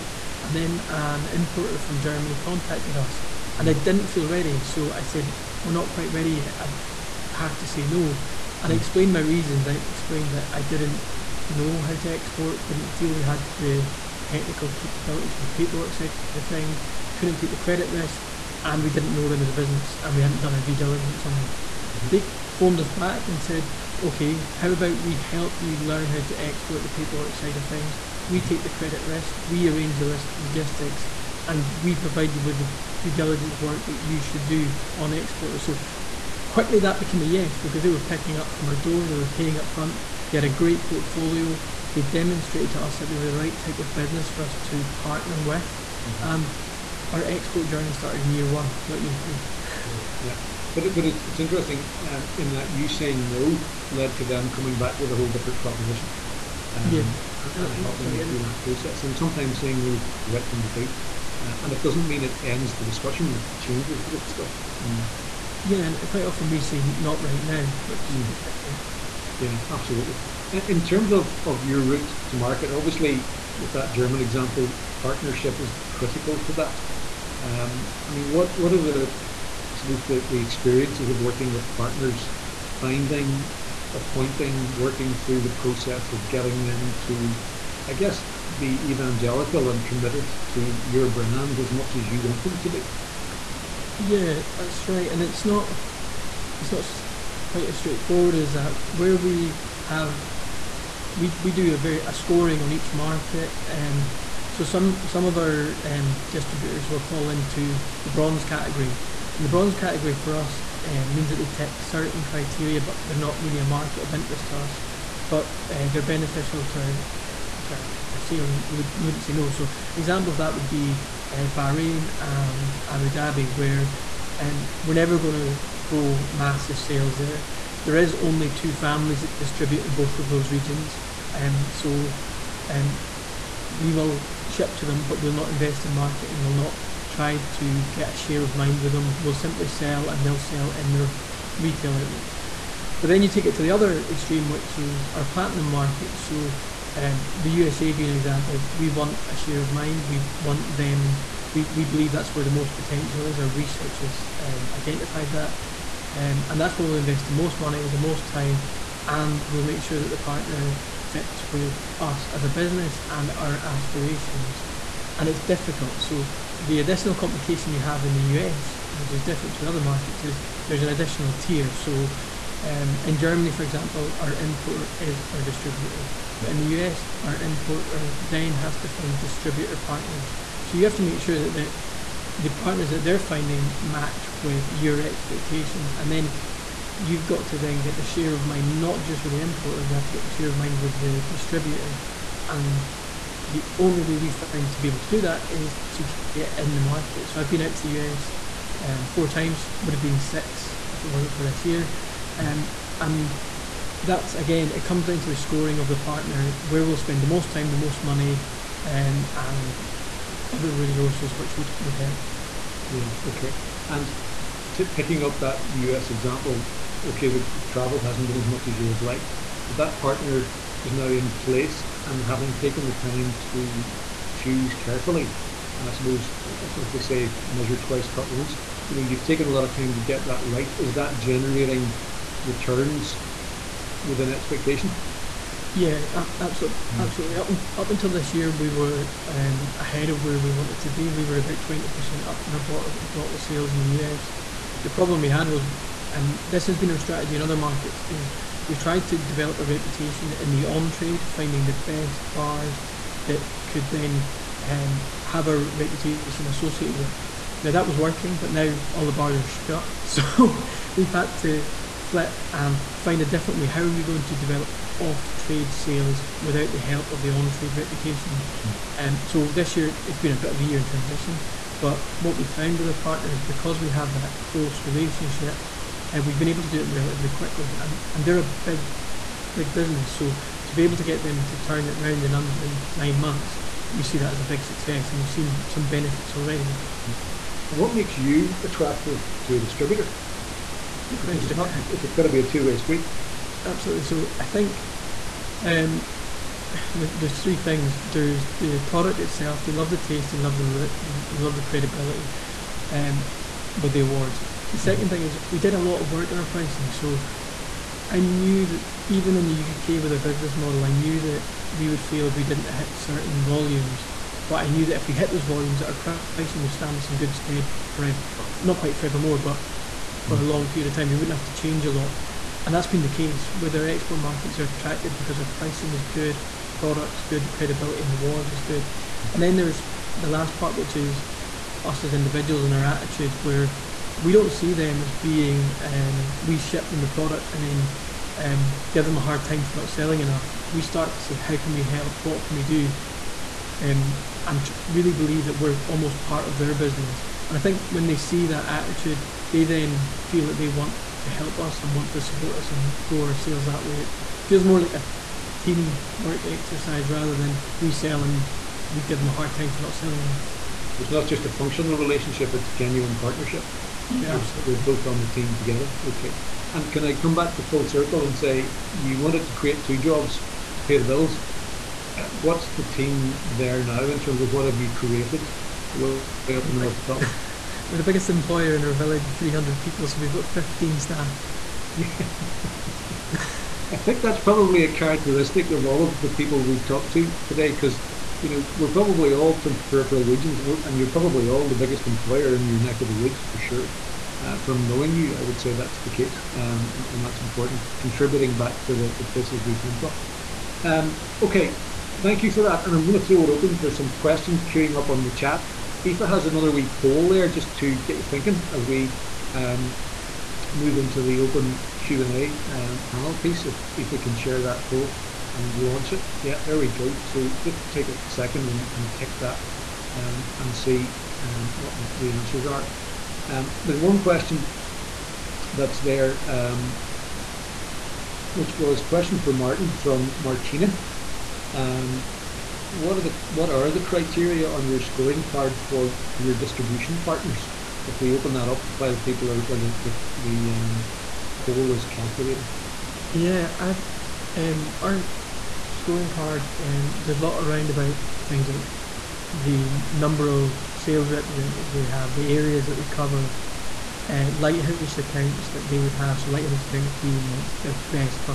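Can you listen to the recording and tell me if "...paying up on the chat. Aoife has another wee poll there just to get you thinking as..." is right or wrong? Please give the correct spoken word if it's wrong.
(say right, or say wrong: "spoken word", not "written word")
wrong: "queuing", not "paying".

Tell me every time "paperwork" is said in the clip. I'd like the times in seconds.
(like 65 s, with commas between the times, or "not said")
15 s, 26 s.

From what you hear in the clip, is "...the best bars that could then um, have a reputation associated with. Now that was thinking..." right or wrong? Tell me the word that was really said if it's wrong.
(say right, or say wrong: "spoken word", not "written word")
wrong: "working", not "thinking".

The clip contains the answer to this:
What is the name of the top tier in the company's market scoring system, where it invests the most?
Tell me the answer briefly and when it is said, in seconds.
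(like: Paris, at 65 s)
Platinum, at 145 s.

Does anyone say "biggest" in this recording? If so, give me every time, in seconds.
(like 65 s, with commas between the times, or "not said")
378 s, 391 s.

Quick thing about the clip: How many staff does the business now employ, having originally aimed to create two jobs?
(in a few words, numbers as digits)
15.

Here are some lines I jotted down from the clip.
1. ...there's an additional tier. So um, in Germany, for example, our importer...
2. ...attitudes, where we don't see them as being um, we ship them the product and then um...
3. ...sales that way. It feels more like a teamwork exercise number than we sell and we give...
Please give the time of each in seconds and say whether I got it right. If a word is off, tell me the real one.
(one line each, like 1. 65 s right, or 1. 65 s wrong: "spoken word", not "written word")
1. 170 s right
2. 332 s right
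3. 353 s wrong: "rather", not "number".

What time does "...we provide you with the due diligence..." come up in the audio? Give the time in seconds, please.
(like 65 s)
31 s.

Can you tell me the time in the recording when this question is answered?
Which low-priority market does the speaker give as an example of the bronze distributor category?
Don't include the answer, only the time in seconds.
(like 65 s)
121 s.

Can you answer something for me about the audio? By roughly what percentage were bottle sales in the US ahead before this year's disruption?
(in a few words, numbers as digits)
20%.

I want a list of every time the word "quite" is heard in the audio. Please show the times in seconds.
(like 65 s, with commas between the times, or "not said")
5 s, 66 s, 97 s, 318 s.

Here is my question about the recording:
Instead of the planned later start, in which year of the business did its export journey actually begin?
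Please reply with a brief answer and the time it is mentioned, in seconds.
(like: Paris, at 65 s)
Year one, at 48 s.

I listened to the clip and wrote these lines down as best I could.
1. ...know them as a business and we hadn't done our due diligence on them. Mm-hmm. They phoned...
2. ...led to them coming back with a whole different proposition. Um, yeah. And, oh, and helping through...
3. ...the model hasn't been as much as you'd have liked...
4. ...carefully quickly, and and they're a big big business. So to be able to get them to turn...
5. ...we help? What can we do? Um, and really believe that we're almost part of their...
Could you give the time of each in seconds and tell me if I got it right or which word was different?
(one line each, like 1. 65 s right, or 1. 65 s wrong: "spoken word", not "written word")
1. 19 s right
2. 53 s right
3. 217 s wrong: "travel", not "model"
4. 276 s wrong: "relatively", not "carefully"
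5. 341 s right.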